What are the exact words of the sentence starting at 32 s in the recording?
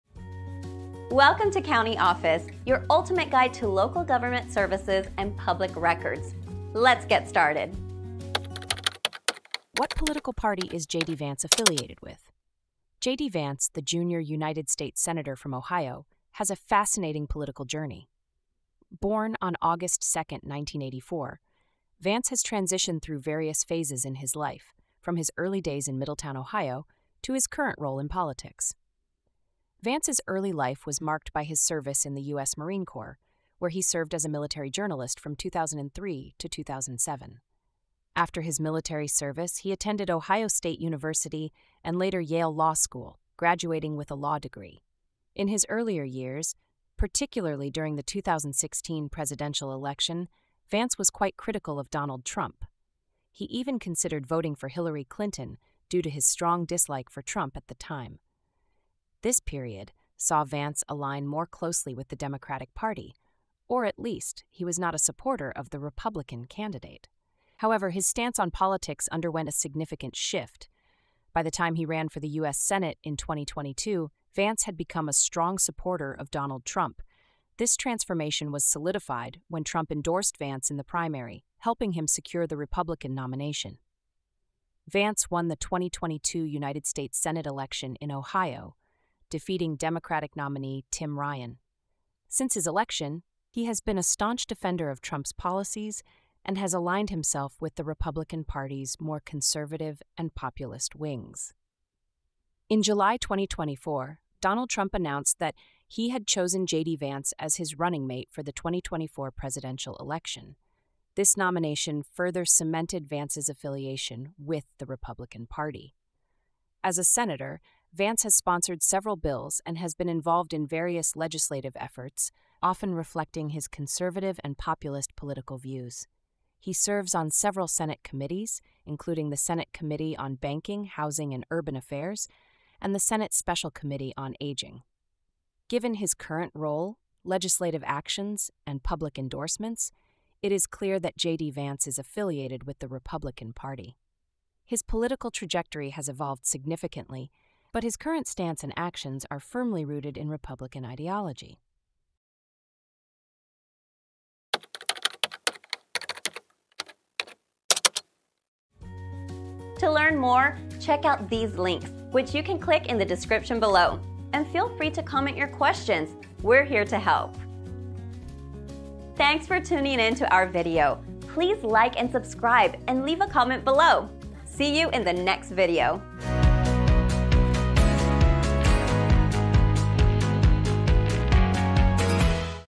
Marine Corps, where he served as a military journalist from 2003 to 2007.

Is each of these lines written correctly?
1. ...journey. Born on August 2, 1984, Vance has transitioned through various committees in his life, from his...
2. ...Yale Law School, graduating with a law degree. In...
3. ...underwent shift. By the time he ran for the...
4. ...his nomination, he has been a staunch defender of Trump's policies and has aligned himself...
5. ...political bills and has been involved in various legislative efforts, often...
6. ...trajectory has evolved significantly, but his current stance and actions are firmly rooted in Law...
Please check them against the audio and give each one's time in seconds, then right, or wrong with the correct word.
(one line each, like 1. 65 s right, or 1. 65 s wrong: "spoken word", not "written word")
1. 17 s wrong: "phases", not "committees"
2. 42 s right
3. 69 s wrong: "significant", not "underwent"
4. 92 s wrong: "election", not "nomination"
5. 118 s wrong: "several", not "political"
6. 145 s wrong: "Republican", not "Law".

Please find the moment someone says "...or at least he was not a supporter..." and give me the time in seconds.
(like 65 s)
63 s.